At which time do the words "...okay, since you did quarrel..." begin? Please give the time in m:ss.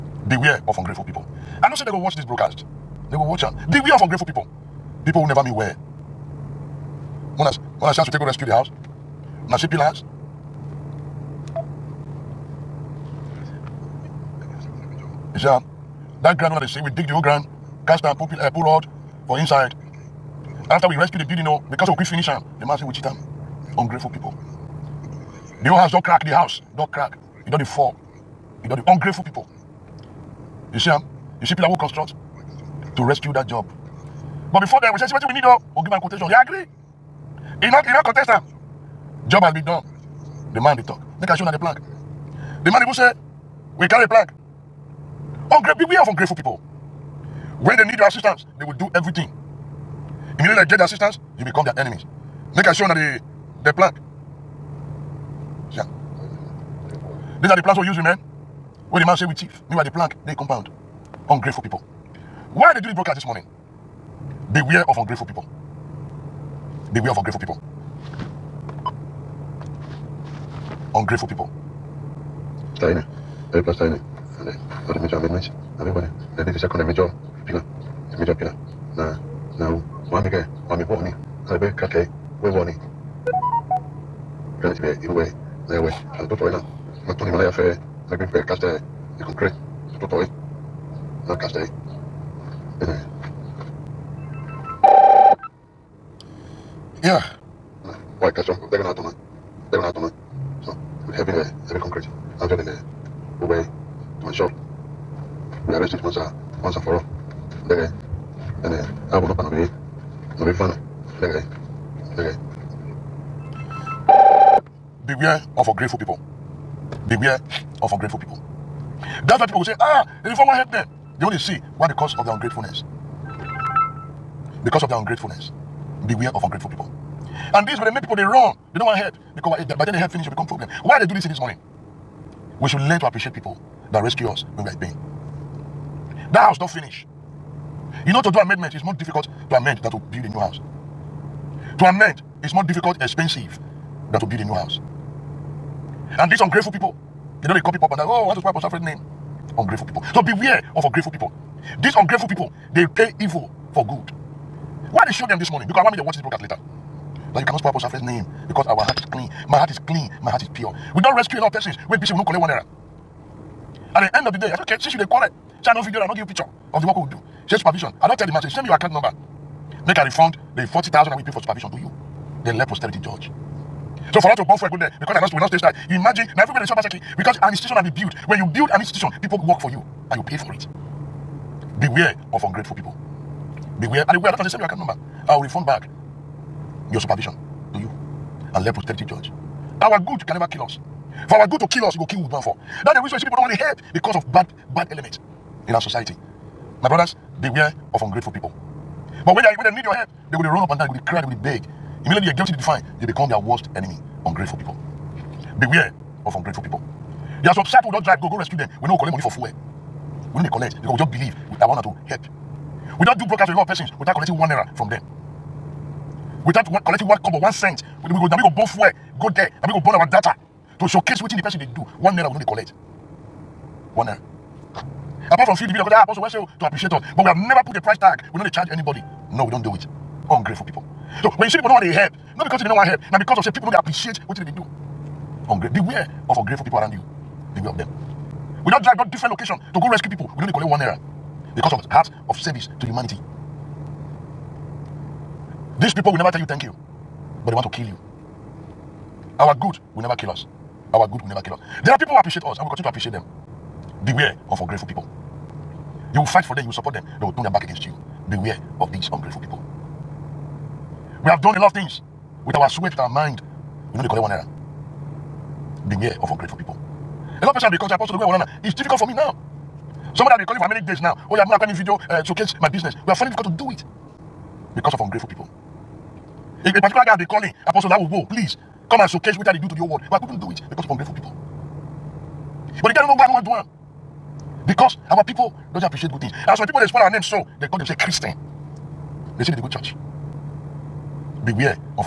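2:44.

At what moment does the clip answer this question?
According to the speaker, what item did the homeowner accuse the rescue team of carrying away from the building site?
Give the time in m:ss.
0:44.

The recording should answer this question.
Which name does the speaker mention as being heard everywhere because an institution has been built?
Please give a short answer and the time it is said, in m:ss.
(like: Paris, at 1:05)
Obaseki, at 2:56.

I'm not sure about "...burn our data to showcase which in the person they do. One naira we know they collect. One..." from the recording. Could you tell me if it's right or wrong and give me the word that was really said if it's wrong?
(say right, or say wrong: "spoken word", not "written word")
right.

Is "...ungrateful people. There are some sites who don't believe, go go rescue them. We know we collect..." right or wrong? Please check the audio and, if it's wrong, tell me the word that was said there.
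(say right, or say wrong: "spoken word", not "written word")
wrong: "drive", not "believe".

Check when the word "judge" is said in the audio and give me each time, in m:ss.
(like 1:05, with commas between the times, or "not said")
2:53, 3:09.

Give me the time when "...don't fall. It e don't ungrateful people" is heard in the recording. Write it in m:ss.
0:27.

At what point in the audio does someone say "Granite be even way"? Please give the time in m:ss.
1:24.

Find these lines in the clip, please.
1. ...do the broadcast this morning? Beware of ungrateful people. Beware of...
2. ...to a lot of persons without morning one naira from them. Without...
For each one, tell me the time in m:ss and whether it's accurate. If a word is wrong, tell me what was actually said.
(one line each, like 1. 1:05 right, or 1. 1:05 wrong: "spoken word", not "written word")
1. 1:02 right
2. 3:33 wrong: "collecting", not "morning".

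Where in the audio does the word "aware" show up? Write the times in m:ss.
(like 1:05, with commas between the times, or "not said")
3:04.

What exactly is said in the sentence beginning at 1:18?
Now, now, one mega, one me warning.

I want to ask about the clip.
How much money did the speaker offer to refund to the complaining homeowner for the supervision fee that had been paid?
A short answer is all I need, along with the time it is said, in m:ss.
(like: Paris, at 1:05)
40,000, at 2:50.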